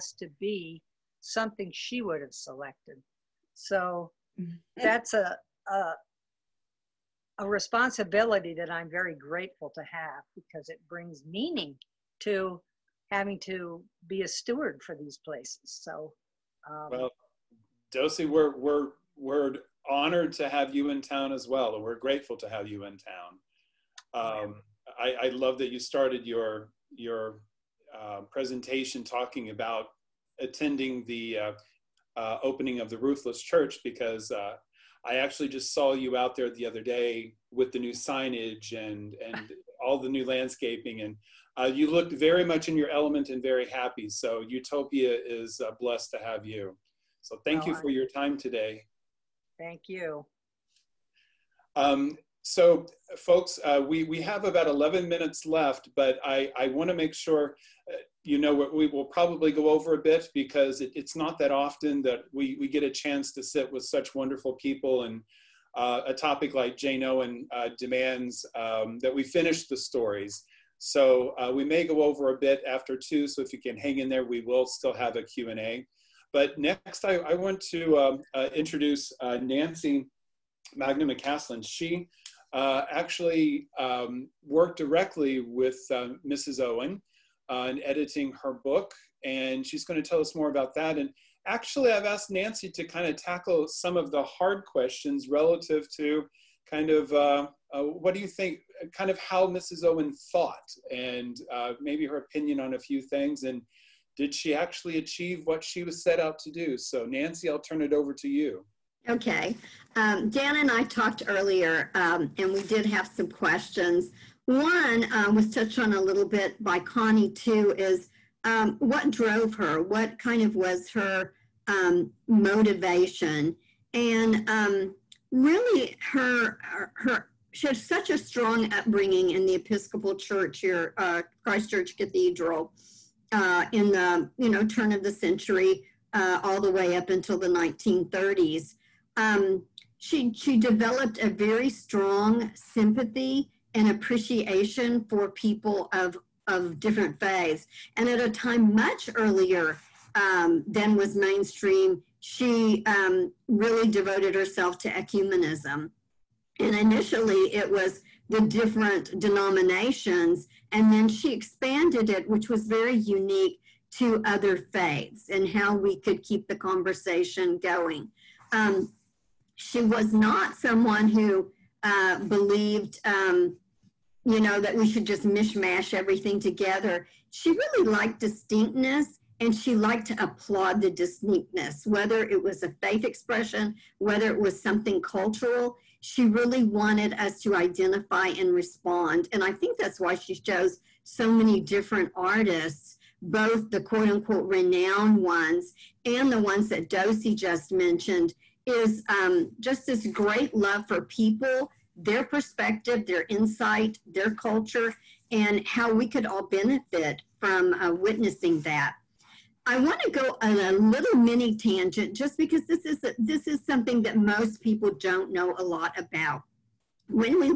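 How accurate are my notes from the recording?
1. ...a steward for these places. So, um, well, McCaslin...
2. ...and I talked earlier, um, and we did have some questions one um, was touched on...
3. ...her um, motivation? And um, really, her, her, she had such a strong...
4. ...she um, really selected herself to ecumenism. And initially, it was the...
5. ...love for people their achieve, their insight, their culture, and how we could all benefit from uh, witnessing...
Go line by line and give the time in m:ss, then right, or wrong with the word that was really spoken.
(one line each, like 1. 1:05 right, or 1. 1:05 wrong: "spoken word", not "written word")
1. 0:14 wrong: "Docey", not "McCaslin"
2. 1:50 right
3. 2:00 right
4. 2:32 wrong: "devoted", not "selected"
5. 3:20 wrong: "perspective", not "achieve".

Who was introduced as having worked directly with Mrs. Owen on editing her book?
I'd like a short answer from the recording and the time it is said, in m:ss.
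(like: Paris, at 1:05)
Nancy Mangum McCaslin, at 1:19.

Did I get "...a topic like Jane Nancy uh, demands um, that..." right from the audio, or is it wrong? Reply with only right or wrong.
wrong.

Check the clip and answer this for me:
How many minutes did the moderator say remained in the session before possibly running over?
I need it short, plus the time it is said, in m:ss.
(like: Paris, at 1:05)
11, at 0:54.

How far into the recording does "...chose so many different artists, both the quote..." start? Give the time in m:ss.
3:10.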